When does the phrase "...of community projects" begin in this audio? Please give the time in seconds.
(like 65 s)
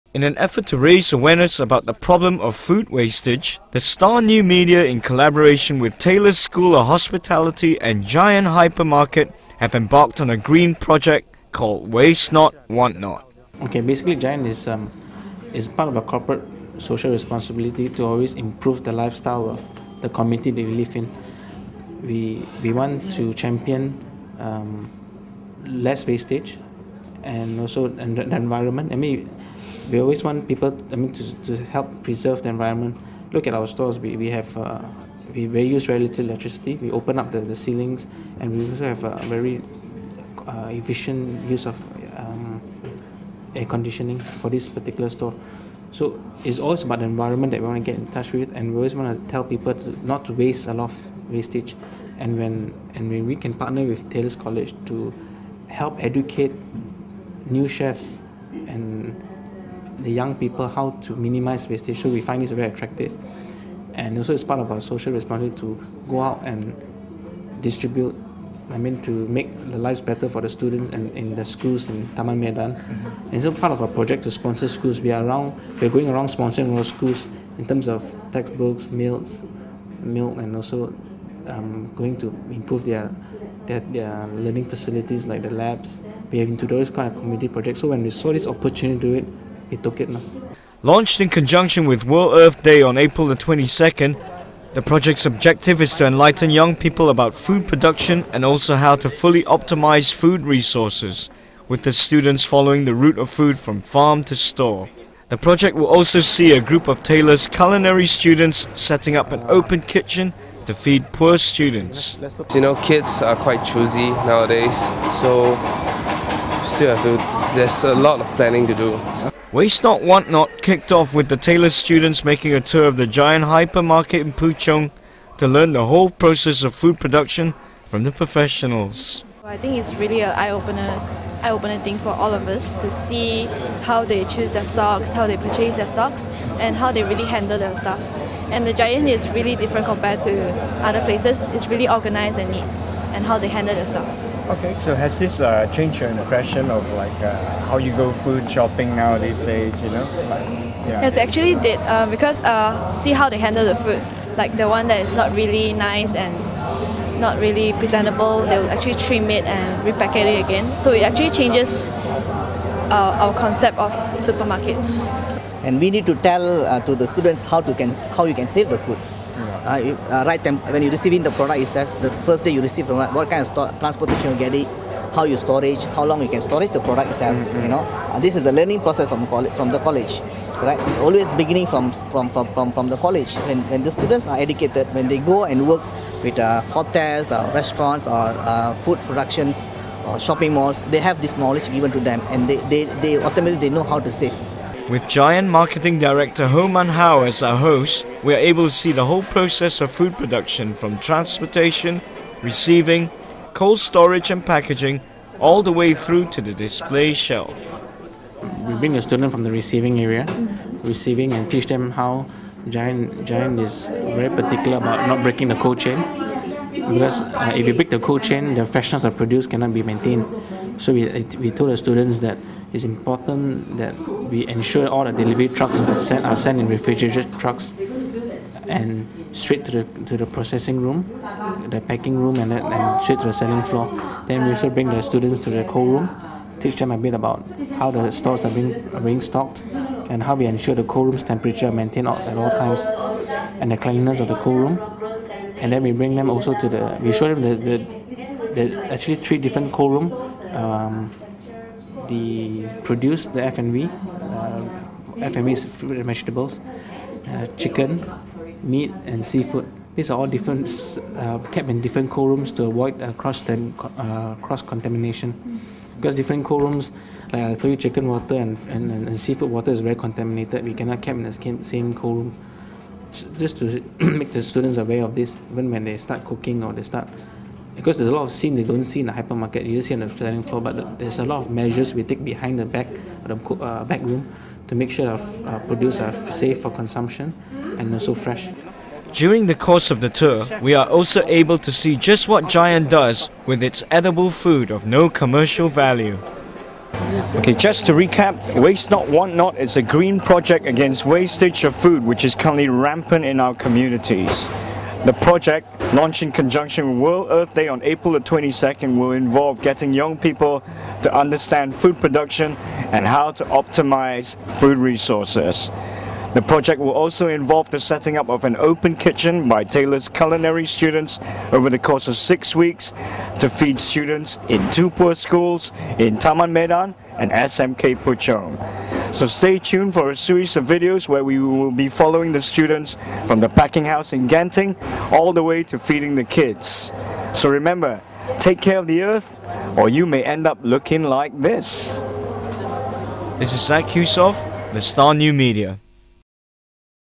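87 s.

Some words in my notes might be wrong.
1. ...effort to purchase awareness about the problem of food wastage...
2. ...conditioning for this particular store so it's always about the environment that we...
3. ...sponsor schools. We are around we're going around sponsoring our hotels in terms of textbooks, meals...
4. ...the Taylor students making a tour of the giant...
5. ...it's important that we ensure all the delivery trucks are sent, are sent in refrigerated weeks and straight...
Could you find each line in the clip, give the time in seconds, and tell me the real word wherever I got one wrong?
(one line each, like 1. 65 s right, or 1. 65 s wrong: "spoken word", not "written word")
1. 0 s wrong: "raise", not "purchase"
2. 43 s right
3. 74 s wrong: "schools", not "hotels"
4. 121 s right
5. 222 s wrong: "trucks", not "weeks".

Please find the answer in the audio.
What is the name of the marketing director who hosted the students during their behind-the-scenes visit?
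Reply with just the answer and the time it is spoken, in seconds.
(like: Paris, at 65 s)
Homan Howe, at 196 s.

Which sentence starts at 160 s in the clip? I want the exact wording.
So it actually changes uh, our concept of supermarkets.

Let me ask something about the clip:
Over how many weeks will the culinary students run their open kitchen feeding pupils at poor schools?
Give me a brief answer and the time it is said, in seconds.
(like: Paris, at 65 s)
6, at 322 s.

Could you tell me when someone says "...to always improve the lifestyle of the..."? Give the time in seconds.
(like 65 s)
17 s.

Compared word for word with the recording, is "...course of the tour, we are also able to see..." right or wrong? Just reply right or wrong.
right.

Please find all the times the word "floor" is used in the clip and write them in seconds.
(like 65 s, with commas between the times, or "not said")
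233 s, 280 s.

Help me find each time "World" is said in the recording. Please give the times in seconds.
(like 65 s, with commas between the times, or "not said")
92 s, 307 s.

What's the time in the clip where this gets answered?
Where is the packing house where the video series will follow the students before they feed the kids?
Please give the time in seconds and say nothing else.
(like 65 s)
334 s.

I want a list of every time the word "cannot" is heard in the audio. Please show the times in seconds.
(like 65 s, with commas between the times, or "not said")
219 s, 270 s.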